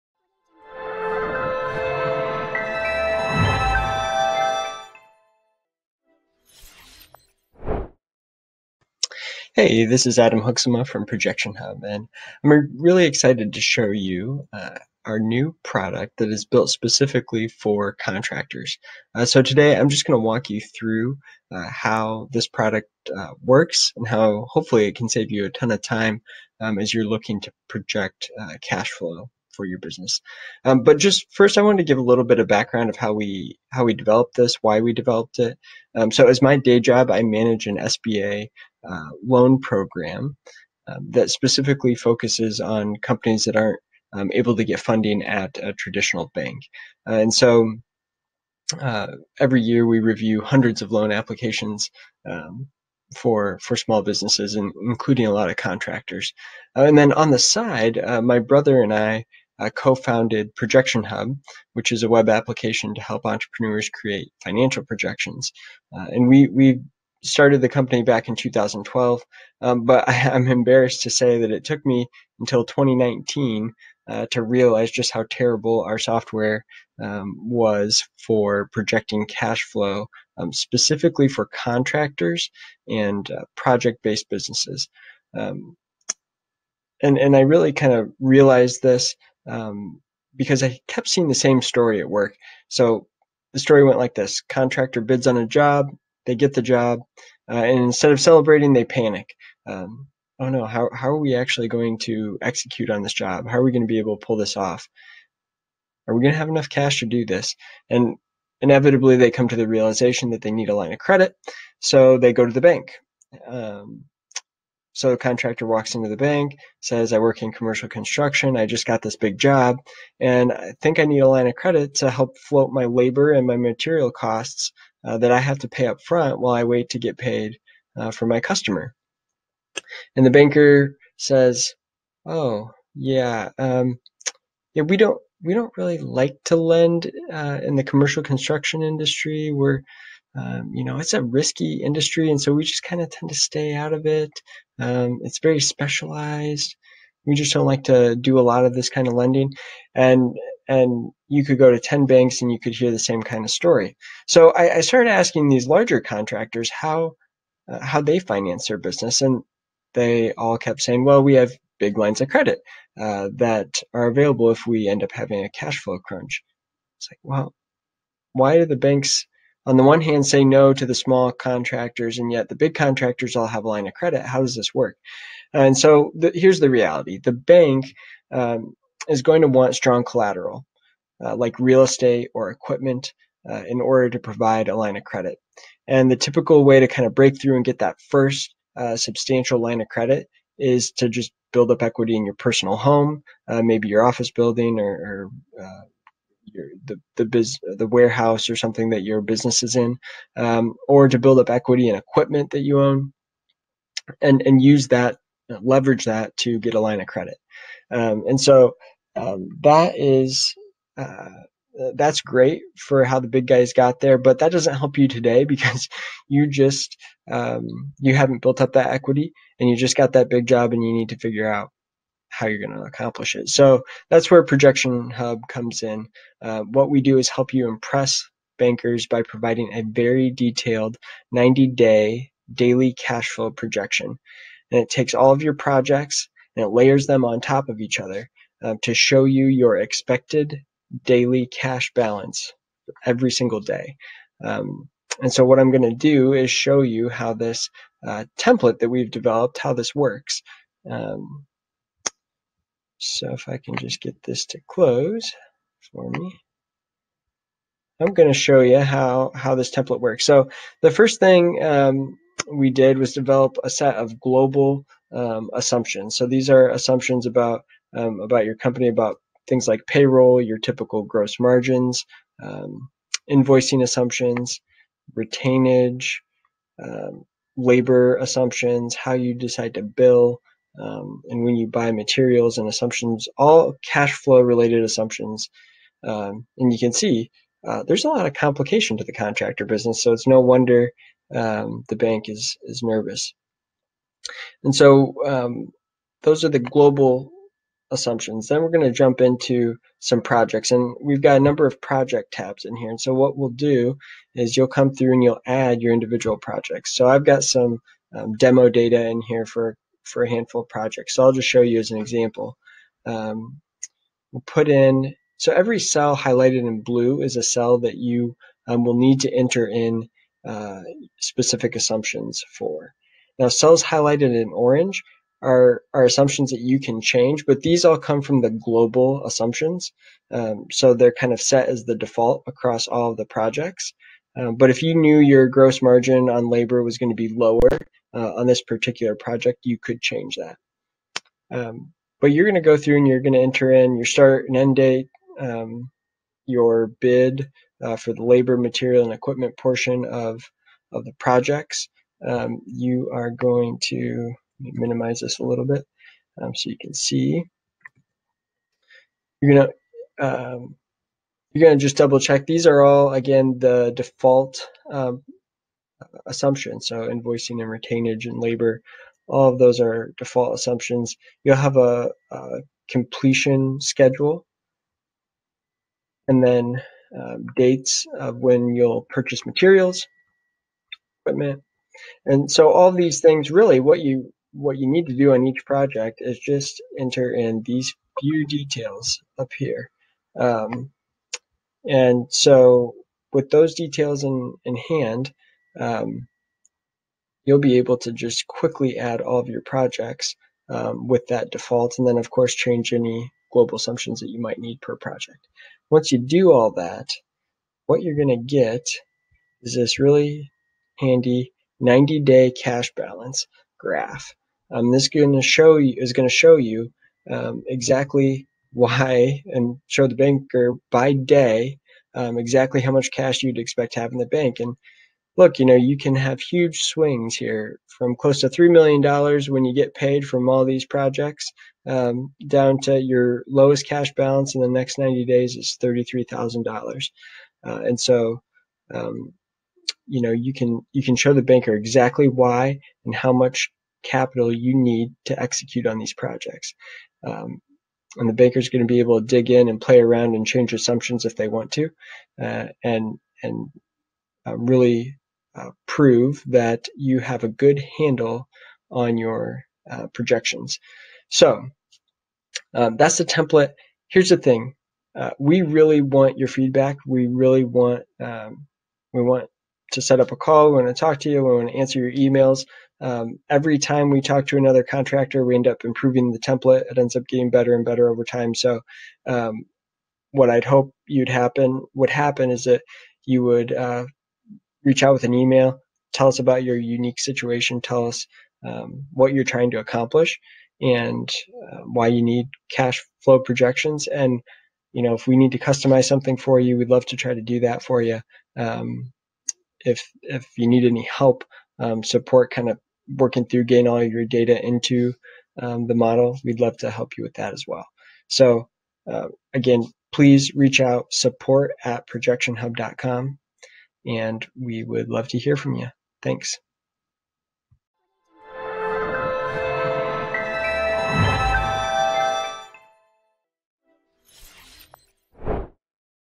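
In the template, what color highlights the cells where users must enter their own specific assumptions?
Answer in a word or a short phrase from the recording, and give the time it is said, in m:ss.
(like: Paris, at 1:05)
Blue, at 5:16.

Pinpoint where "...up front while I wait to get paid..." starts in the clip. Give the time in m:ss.
2:05.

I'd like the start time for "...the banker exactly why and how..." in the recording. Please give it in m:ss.
7:21.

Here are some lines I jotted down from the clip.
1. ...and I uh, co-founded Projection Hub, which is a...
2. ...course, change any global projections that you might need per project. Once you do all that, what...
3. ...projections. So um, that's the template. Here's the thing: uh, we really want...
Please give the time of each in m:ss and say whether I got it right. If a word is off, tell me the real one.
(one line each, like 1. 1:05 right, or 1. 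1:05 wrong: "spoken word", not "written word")
1. 0:58 right
2. 6:42 wrong: "assumptions", not "projections"
3. 7:40 right.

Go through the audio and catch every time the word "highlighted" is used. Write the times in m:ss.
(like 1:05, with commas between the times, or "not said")
5:16, 5:23.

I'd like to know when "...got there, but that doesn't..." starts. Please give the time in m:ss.
3:33.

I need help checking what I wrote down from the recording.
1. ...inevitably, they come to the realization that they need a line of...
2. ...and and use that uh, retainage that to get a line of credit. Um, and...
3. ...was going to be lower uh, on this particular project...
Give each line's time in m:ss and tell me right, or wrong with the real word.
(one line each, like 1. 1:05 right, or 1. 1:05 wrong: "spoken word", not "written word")
1. 1:48 right
2. 3:24 wrong: "leverage", not "retainage"
3. 5:36 right.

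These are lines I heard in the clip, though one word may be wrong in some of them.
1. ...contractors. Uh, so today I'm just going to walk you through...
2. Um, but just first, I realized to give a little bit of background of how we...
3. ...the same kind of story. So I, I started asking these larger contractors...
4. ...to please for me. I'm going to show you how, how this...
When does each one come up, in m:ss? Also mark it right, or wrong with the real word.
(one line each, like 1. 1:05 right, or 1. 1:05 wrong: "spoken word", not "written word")
1. 0:17 right
2. 0:30 wrong: "wanted", not "realized"
3. 2:32 right
4. 4:14 wrong: "close", not "please".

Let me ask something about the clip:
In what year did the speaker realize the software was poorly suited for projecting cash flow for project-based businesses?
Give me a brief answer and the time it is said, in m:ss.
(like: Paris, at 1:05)
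2019, at 1:12.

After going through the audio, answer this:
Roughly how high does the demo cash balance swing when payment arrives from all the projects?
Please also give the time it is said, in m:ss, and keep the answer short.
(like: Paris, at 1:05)
$3 million, at 7:08.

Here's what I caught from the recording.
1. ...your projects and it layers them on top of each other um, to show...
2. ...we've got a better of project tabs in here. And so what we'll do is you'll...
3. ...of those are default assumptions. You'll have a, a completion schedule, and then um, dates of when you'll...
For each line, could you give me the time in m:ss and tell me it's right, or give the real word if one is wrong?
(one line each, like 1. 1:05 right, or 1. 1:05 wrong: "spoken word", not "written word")
1. 3:55 right
2. 5:01 wrong: "number", not "better"
3. 6:09 right.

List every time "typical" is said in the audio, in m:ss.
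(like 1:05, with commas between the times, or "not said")
3:06, 4:30.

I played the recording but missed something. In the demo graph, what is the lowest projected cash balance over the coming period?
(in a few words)
$33,000.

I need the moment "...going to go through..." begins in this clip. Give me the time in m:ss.
5:42.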